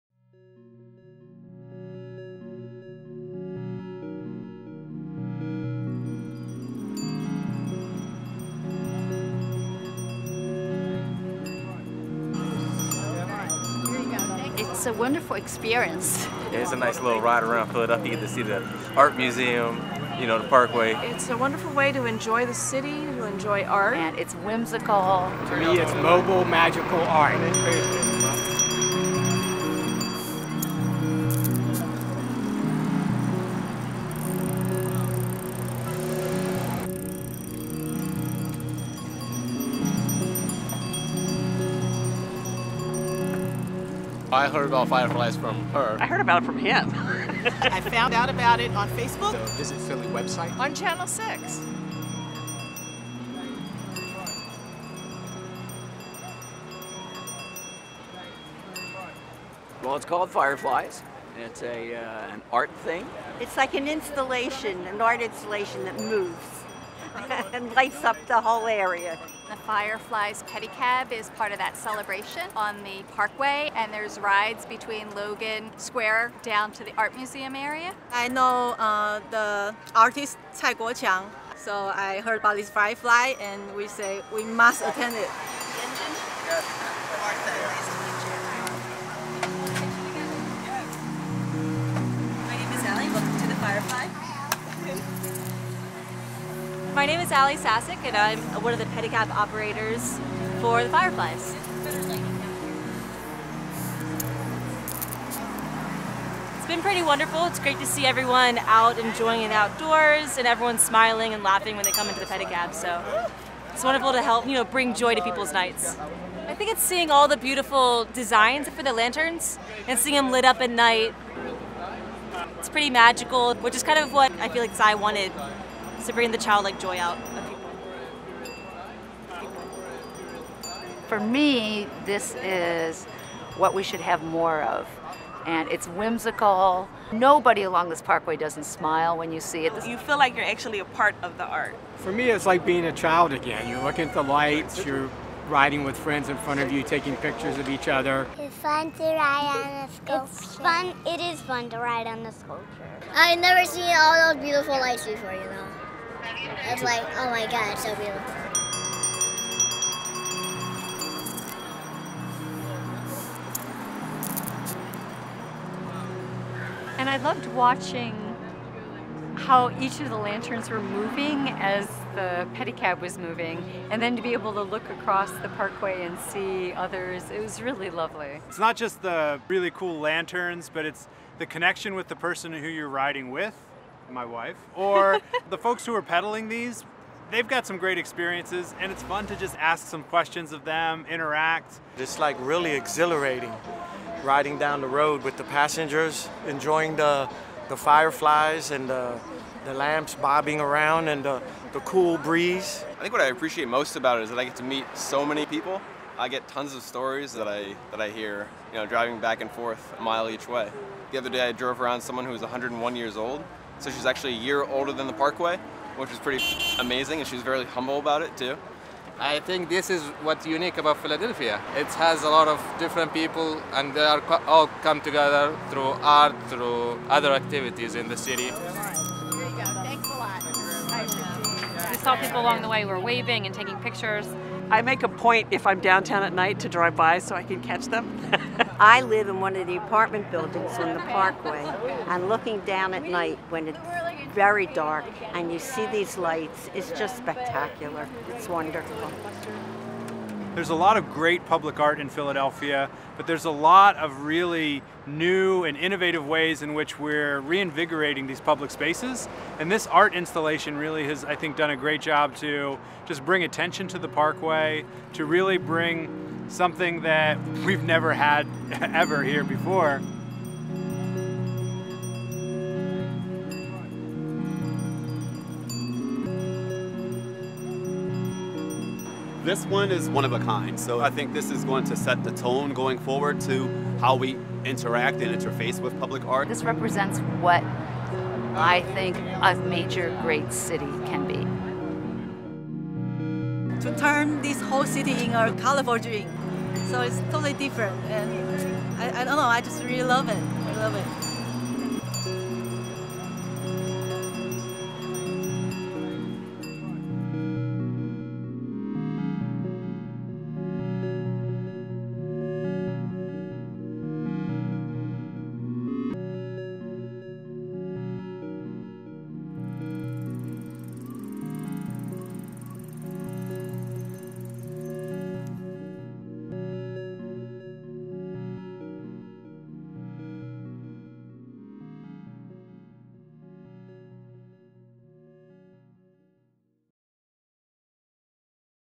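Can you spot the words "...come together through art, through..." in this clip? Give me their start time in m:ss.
3:44.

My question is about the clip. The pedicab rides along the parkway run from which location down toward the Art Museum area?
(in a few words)
Logan Square.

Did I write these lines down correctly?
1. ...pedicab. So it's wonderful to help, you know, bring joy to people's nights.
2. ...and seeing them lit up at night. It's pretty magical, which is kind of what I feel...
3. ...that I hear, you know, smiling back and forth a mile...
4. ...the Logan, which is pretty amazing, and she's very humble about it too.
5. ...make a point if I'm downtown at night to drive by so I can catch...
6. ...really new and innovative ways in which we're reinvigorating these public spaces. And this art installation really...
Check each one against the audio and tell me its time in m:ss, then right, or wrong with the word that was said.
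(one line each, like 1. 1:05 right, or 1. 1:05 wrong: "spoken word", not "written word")
1. 1:52 right
2. 1:59 right
3. 3:27 wrong: "driving", not "smiling"
4. 3:35 wrong: "Parkway", not "Logan"
5. 3:54 right
6. 4:14 right.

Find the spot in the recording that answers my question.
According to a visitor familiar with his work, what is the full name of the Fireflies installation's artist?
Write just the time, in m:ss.
1:20.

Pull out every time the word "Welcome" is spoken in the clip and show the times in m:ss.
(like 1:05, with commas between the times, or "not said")
1:33.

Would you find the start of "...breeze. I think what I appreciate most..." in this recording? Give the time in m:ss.
3:22.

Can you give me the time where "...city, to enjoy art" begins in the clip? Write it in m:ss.
0:22.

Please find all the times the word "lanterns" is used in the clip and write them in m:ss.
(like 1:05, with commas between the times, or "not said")
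1:58, 2:50, 2:59.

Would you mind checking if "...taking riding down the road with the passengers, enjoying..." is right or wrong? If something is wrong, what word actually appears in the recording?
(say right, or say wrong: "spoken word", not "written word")
wrong: "exhilarating", not "taking".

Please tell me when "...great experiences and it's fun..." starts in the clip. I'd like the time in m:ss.
3:07.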